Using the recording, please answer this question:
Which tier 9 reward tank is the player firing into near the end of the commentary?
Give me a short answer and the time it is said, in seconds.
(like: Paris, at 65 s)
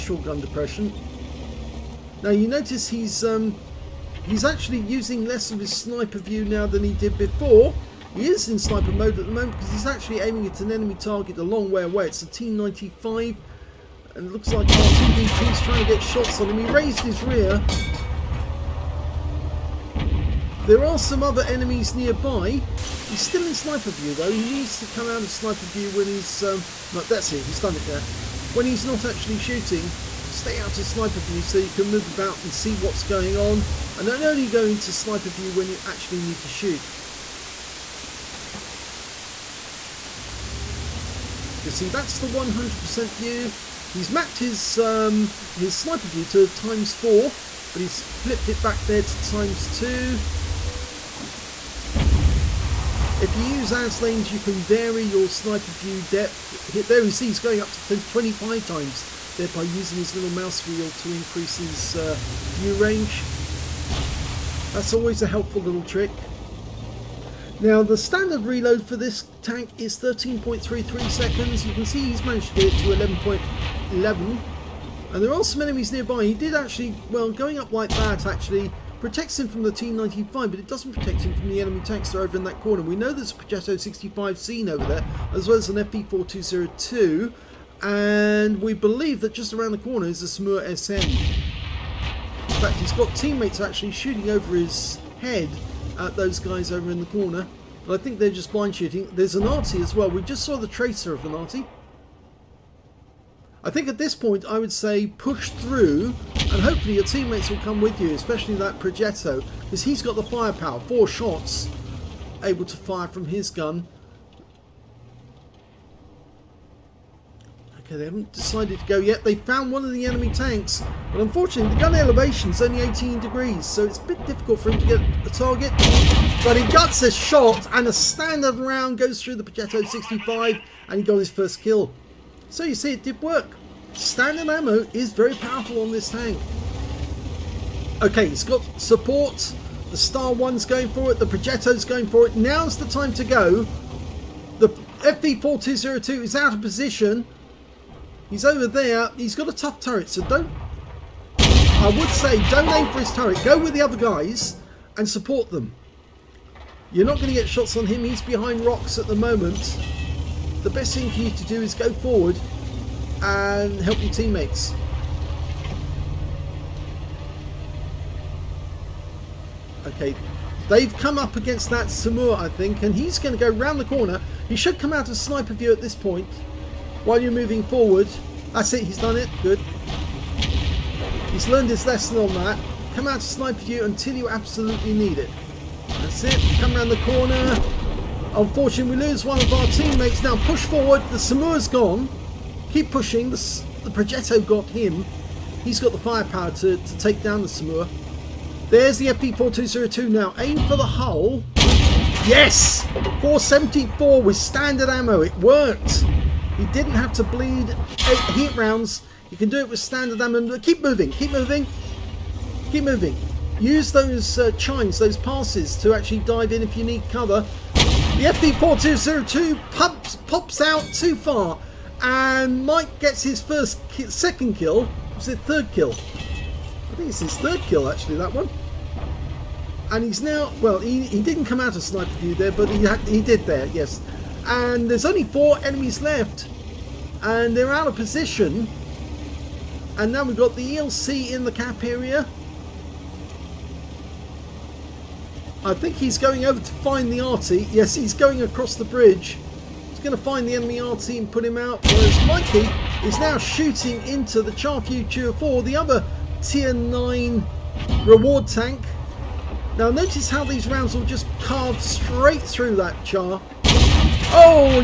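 Char Futur 4, at 254 s.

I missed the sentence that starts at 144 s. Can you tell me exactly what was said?
The FV4202 is out of position.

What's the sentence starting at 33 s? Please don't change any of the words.
And don't only go into sniper view when you actually need to shoot.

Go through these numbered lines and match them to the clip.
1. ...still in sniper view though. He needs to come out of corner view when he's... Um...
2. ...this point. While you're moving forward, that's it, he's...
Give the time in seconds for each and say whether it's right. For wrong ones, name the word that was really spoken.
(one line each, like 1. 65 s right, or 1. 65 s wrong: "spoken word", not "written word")
1. 23 s wrong: "sniper", not "corner"
2. 175 s right.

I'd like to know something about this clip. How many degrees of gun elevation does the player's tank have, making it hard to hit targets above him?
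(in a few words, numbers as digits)
18.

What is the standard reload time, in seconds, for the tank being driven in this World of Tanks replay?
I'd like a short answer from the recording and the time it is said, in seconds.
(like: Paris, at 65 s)
13.33, at 69 s.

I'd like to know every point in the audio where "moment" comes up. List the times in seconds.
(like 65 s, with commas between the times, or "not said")
9 s, 159 s.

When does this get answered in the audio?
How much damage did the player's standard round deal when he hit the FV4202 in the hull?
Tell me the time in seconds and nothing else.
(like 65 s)
203 s.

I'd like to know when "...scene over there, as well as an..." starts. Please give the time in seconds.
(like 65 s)
84 s.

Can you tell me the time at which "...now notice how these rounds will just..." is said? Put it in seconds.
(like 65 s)
259 s.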